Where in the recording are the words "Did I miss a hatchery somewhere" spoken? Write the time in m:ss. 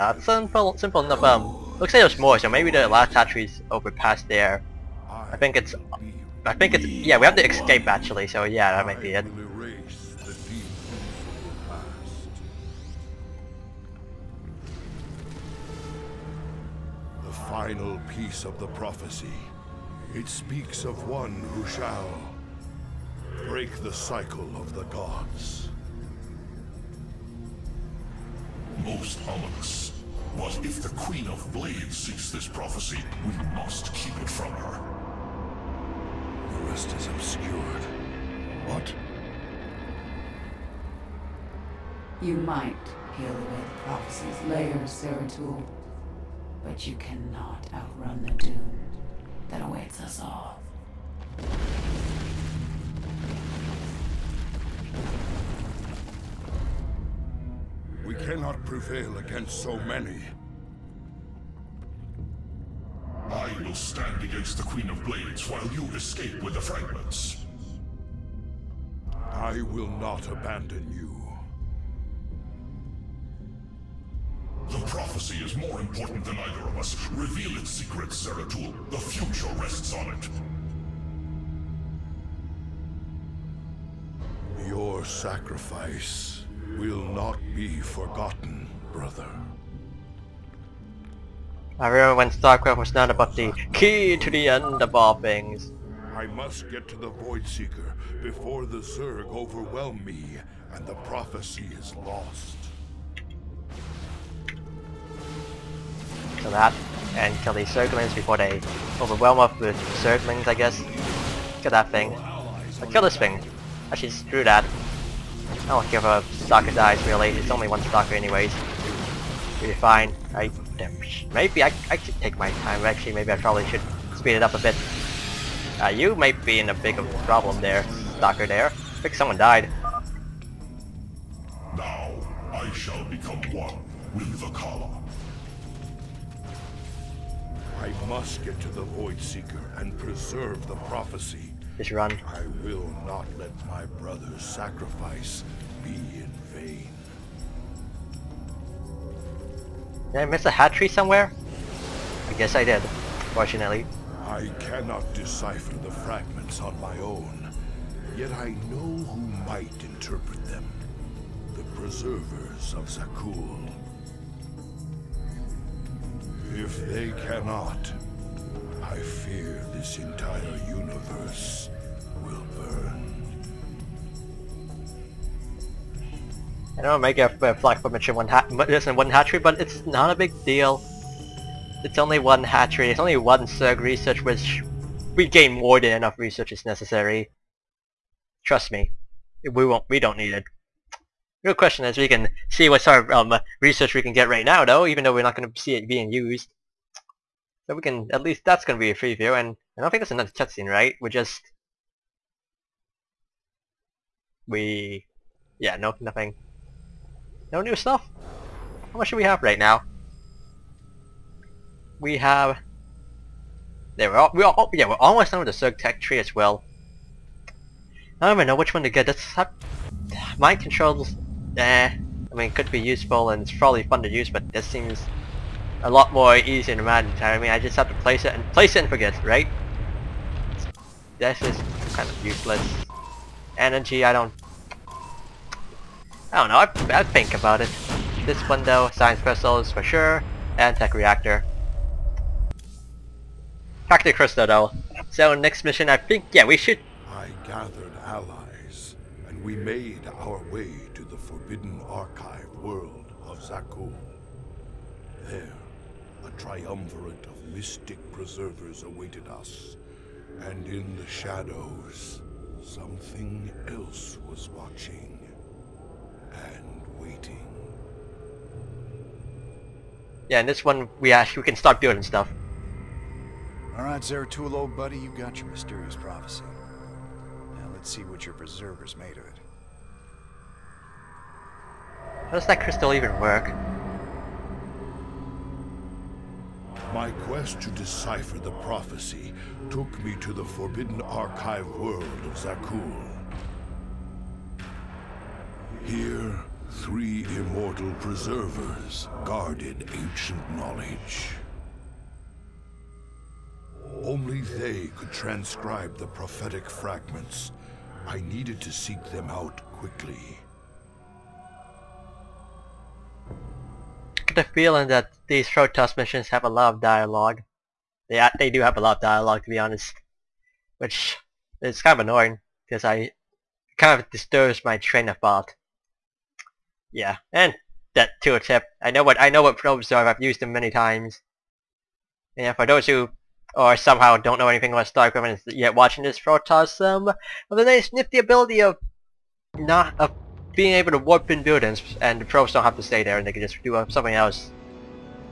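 2:30.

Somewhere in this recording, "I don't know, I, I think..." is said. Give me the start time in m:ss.
3:56.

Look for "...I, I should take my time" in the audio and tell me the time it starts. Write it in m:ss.
2:01.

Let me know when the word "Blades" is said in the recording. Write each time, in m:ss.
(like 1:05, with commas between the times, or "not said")
0:31, 1:05.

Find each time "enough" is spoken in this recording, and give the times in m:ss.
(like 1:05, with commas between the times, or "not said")
0:01, 3:05.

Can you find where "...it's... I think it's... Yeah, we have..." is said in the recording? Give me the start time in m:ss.
0:05.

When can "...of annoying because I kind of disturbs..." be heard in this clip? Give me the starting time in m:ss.
5:21.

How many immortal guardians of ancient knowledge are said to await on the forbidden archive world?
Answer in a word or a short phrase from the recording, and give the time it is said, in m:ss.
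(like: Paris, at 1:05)
3, at 4:56.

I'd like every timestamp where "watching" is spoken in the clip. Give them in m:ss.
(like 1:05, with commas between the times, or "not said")
4:24, 5:35.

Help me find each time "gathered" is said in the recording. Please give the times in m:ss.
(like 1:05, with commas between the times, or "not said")
4:07.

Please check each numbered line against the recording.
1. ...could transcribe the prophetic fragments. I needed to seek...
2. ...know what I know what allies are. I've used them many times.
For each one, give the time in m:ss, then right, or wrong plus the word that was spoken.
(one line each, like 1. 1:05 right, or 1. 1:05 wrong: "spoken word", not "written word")
1. 5:04 right
2. 5:28 wrong: "probes", not "allies".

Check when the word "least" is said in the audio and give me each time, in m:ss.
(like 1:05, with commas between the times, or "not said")
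3:18.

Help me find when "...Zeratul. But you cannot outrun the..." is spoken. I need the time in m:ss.
0:45.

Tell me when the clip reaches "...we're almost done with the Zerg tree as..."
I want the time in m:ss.
3:34.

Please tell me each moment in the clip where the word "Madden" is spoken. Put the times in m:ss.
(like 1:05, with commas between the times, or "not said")
3:46.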